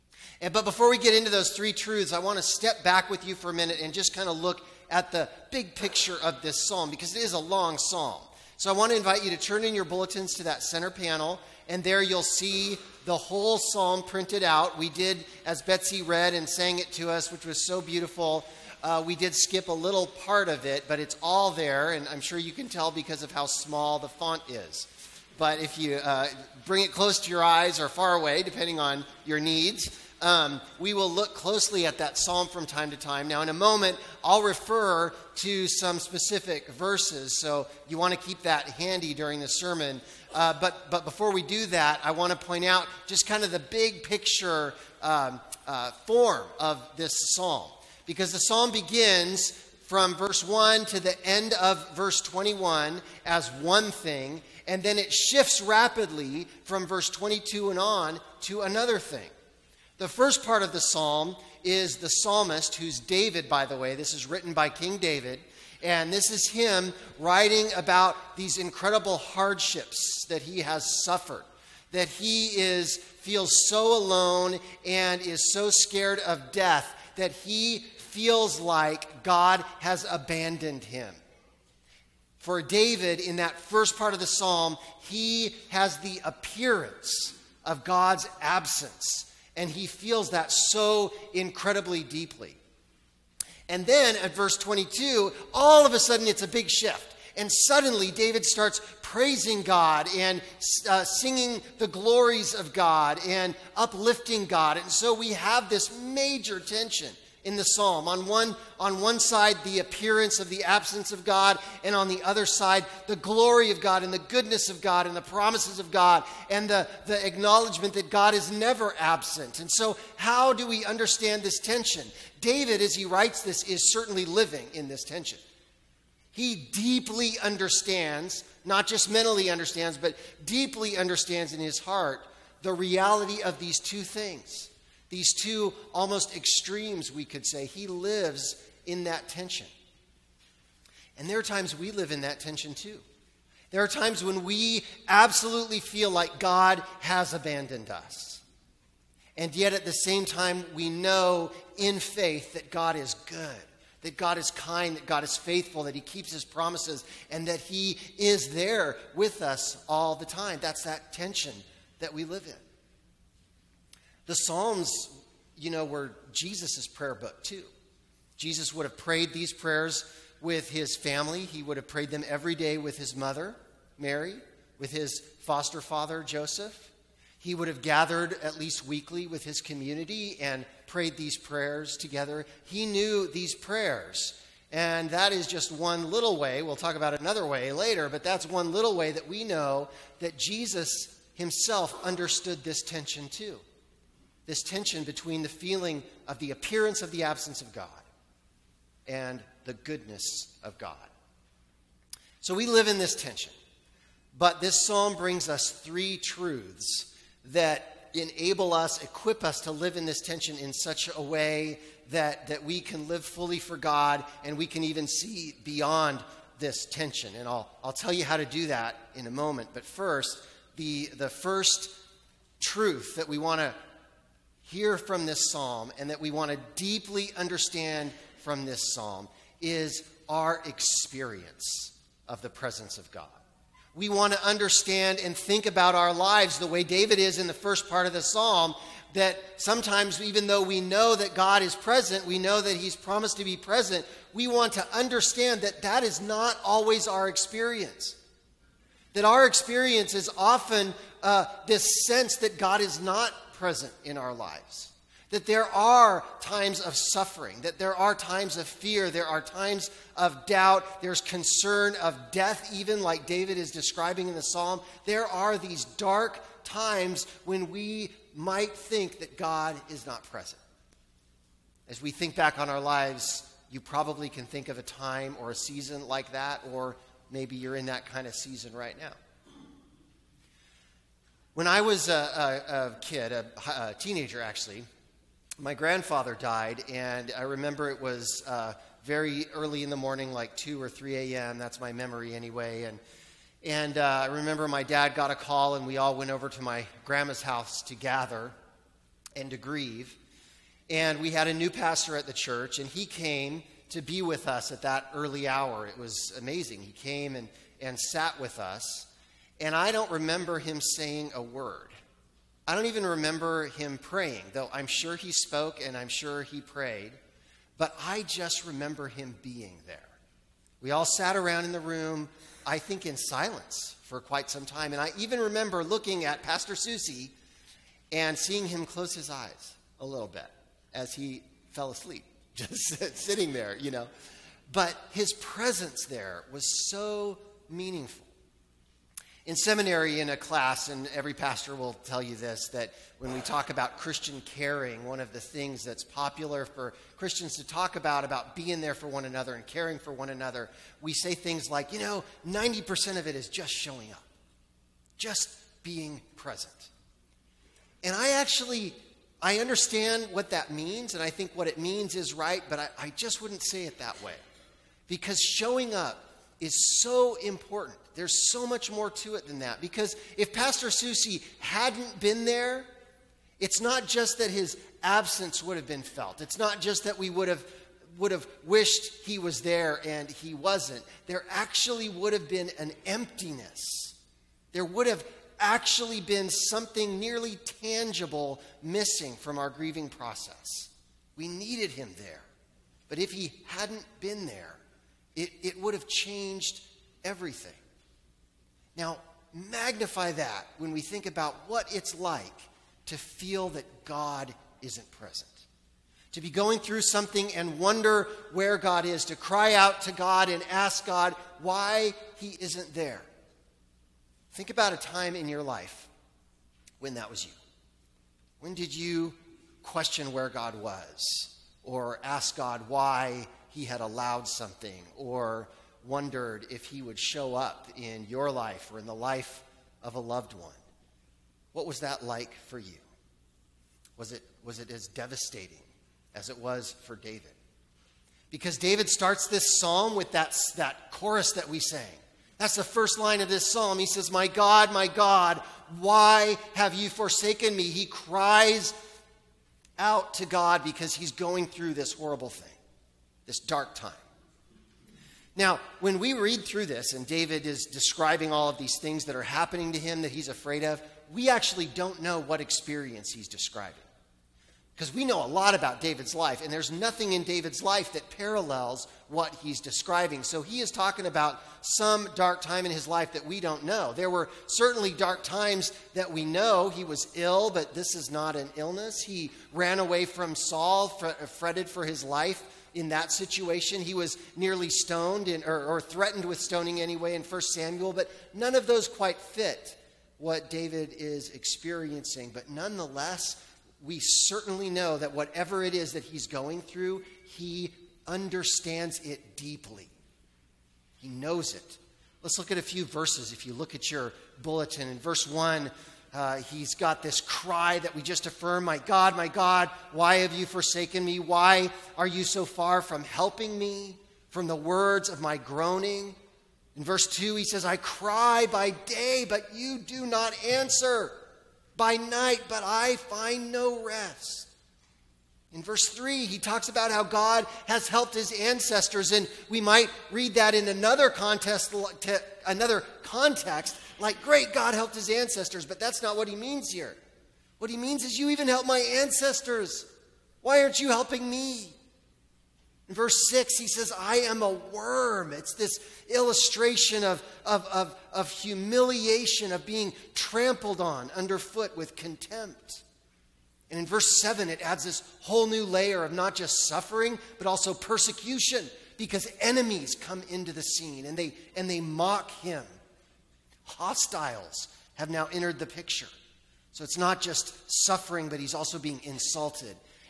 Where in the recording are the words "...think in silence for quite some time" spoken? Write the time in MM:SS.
05:22.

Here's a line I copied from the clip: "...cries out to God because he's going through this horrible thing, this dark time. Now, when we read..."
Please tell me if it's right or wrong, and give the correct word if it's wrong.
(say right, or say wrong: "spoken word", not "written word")
right.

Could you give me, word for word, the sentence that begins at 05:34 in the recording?
But his presence there was so meaningful.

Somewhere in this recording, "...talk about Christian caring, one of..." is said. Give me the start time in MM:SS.
05:43.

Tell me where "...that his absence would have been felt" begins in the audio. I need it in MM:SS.
06:14.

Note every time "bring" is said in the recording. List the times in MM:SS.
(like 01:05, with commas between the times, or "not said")
00:26, 03:25.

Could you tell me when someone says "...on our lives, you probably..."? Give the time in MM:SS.
04:32.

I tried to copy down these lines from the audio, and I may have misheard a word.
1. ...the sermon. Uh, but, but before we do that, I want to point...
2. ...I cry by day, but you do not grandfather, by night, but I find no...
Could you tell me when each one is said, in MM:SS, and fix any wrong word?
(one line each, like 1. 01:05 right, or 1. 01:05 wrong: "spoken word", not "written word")
1. 00:39 right
2. 08:37 wrong: "answer", not "grandfather".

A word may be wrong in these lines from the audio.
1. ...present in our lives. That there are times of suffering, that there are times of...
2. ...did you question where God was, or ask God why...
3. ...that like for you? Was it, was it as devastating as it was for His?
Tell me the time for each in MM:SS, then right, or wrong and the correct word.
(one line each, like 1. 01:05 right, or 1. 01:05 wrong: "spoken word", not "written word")
1. 04:13 right
2. 06:58 right
3. 07:12 wrong: "David", not "His".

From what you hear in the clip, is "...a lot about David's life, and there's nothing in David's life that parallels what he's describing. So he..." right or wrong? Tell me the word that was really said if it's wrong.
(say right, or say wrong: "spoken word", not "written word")
right.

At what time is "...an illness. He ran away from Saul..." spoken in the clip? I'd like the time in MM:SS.
07:58.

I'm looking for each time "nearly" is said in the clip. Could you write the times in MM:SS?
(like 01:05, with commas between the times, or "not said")
06:27, 08:04.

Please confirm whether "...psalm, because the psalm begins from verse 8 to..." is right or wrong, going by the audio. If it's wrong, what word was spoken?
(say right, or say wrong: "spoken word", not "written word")
wrong: "1", not "8".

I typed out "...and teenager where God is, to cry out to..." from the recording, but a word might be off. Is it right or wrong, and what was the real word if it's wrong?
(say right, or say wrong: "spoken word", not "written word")
wrong: "wonder", not "teenager".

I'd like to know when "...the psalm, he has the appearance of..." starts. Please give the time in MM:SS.
01:24.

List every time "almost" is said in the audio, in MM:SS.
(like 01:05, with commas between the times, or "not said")
02:15.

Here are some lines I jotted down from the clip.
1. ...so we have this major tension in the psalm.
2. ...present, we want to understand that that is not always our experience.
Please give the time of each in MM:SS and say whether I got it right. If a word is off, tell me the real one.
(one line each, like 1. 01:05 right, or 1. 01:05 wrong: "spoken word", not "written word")
1. 01:44 right
2. 04:03 right.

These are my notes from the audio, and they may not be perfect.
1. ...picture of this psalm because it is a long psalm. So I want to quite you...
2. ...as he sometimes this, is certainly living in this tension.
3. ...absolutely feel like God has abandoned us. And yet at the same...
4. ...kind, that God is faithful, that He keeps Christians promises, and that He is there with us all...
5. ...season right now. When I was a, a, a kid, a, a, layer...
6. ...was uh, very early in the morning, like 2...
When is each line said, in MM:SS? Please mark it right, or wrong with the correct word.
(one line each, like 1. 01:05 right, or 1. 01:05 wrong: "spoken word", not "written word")
1. 00:05 wrong: "invite", not "quite"
2. 02:02 wrong: "writes", not "sometimes"
3. 02:25 right
4. 02:34 wrong: "His", not "Christians"
5. 04:38 wrong: "teenager", not "layer"
6. 04:48 right.